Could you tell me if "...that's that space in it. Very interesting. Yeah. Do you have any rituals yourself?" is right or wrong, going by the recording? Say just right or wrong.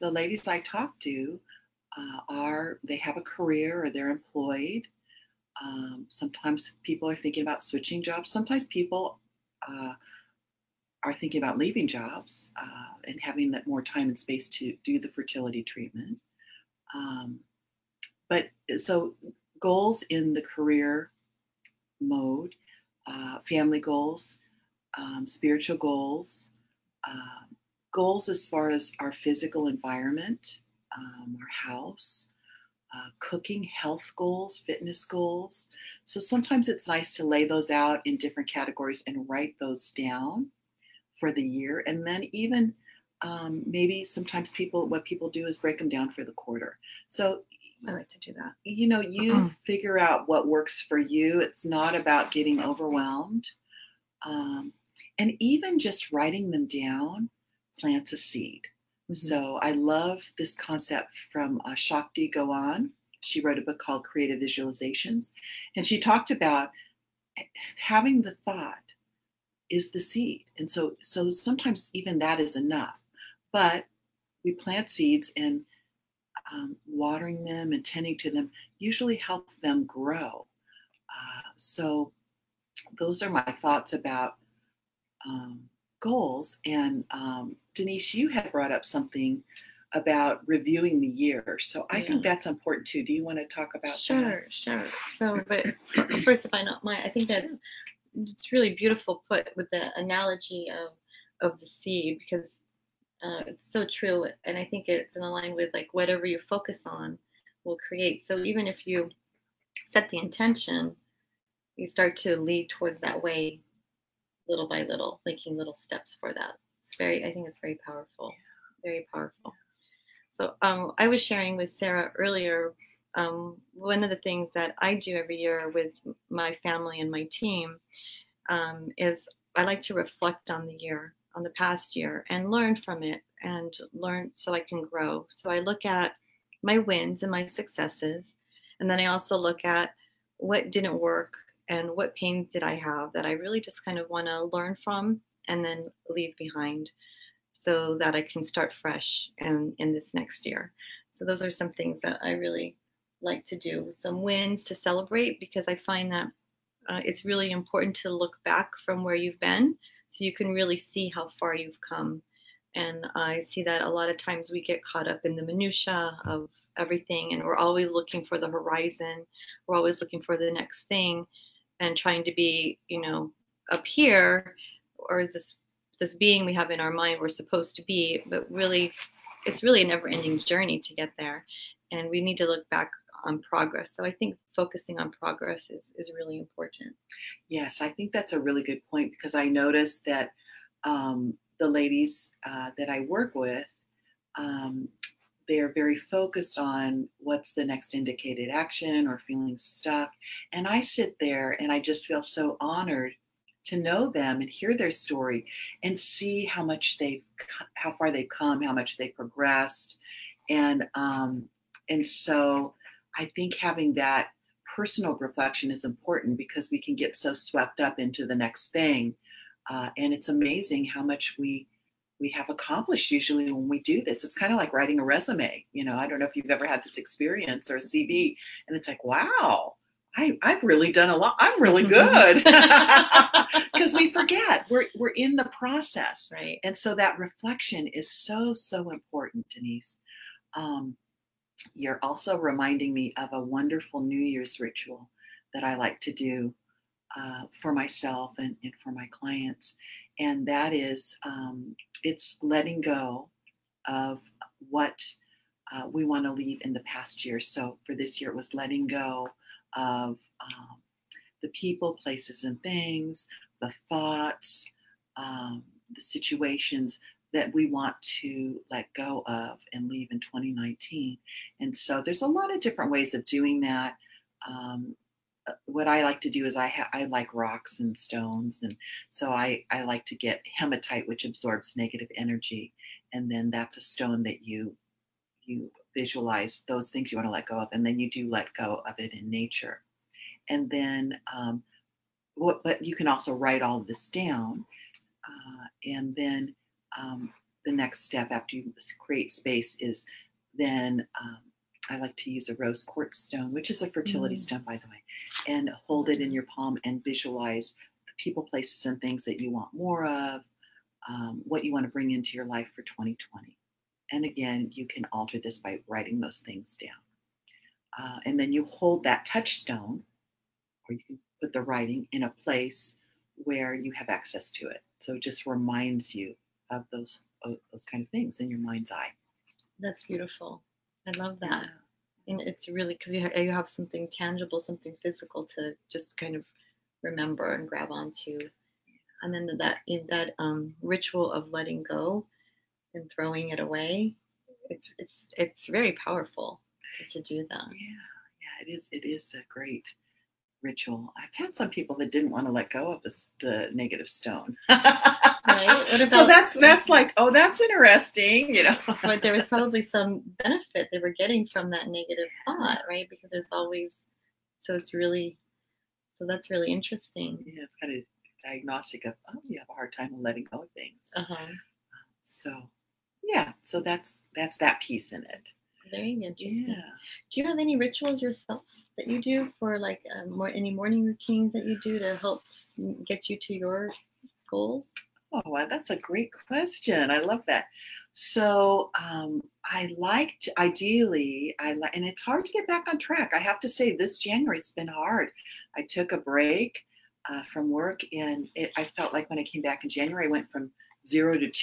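wrong.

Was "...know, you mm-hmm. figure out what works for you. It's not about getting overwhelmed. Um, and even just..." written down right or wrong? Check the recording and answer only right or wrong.
right.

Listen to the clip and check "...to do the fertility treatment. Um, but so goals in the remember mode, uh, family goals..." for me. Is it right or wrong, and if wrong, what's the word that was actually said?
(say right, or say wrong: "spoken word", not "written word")
wrong: "career", not "remember".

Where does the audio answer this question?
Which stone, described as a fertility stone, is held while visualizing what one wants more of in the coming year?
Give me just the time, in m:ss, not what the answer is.
5:02.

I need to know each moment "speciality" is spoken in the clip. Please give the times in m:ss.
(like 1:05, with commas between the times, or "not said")
not said.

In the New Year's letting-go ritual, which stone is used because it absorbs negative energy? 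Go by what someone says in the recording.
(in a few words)
hematite.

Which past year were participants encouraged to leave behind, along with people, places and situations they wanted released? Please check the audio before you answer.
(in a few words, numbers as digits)
2019.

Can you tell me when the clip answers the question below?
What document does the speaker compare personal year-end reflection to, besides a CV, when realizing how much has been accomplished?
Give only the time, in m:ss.
3:45.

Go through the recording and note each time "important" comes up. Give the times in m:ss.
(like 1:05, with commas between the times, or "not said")
1:32, 2:37, 3:06, 3:35, 3:58.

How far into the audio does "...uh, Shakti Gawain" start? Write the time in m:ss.
1:01.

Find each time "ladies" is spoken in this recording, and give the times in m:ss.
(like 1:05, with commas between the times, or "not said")
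0:00, 3:11.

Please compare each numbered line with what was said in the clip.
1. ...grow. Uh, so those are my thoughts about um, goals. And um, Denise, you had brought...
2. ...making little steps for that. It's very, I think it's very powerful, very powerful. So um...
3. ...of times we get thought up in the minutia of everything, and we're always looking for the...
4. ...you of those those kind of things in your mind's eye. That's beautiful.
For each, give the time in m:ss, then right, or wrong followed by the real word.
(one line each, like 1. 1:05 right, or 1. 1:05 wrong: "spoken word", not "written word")
1. 1:19 right
2. 1:55 right
3. 2:44 wrong: "caught", not "thought"
4. 5:26 right.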